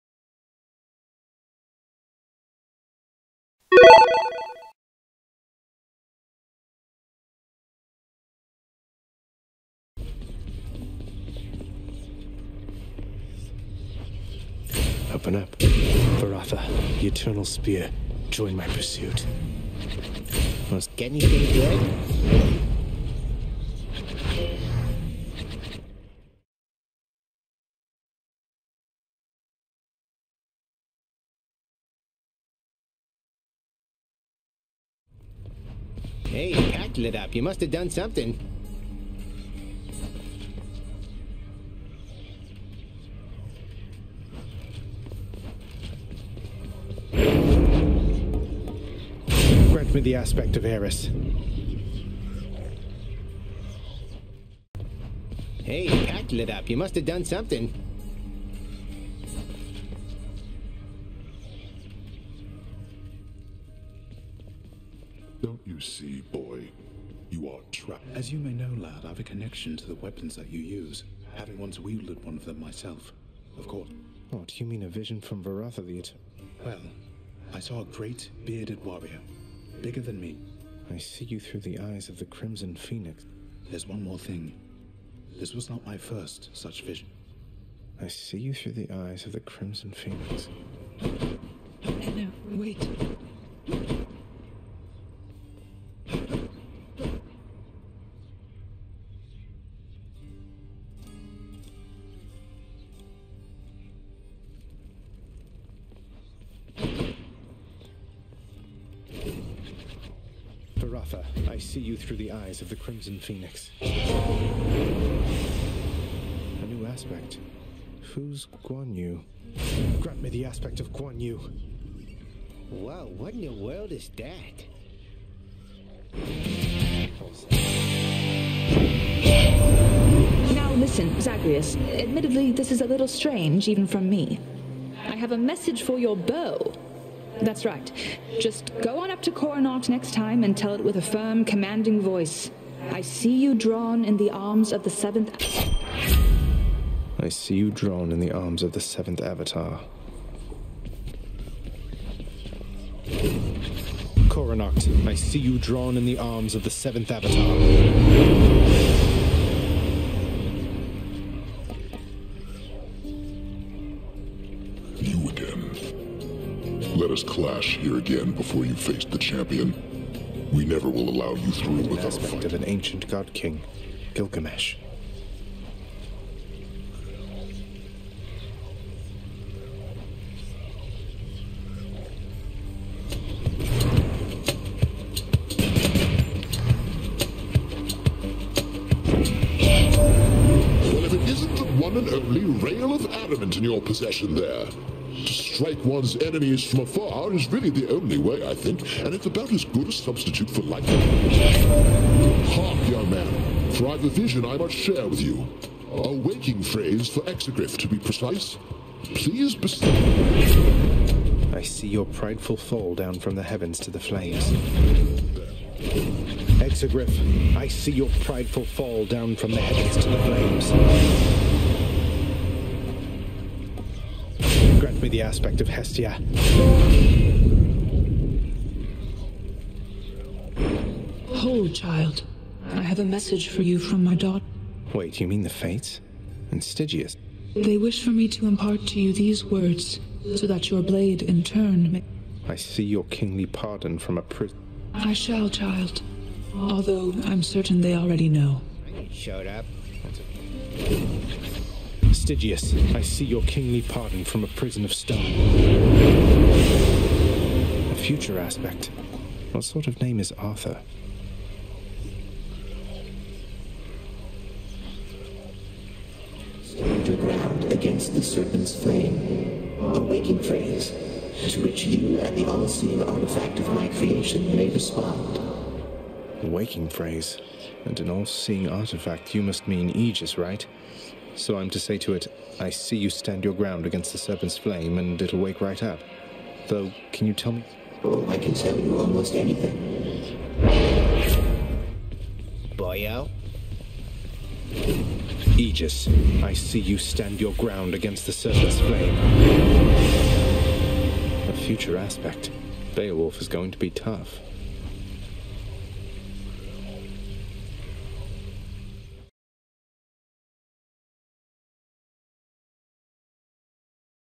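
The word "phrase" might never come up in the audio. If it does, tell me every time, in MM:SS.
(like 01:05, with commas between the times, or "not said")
03:26, 04:30, 04:36.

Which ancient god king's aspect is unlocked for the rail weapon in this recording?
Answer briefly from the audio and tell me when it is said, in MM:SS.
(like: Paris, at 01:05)
Gilgamesh, at 02:54.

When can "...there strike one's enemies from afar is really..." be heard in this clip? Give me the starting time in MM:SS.
03:14.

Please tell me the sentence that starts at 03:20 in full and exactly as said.
Hark, young man, for I've a vision I must share with you.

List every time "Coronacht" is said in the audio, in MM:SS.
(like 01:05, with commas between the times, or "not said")
02:19, 02:34.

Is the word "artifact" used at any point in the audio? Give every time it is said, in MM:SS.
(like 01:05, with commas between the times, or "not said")
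04:33, 04:38.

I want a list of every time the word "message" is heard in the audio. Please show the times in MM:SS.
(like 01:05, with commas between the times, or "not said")
02:15, 03:53.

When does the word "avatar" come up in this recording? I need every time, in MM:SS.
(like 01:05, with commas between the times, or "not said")
02:29, 02:37.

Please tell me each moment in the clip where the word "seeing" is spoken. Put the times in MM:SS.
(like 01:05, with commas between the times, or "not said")
04:32, 04:38.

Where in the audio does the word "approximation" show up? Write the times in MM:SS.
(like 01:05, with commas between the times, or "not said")
not said.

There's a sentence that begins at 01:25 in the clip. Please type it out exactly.
This was not my first such vision.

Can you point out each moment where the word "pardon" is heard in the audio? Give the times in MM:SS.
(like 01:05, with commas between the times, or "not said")
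04:03, 04:13.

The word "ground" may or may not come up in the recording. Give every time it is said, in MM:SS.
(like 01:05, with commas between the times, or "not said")
04:27, 04:43, 04:57.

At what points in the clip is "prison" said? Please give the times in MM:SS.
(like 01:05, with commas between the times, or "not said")
04:04, 04:14.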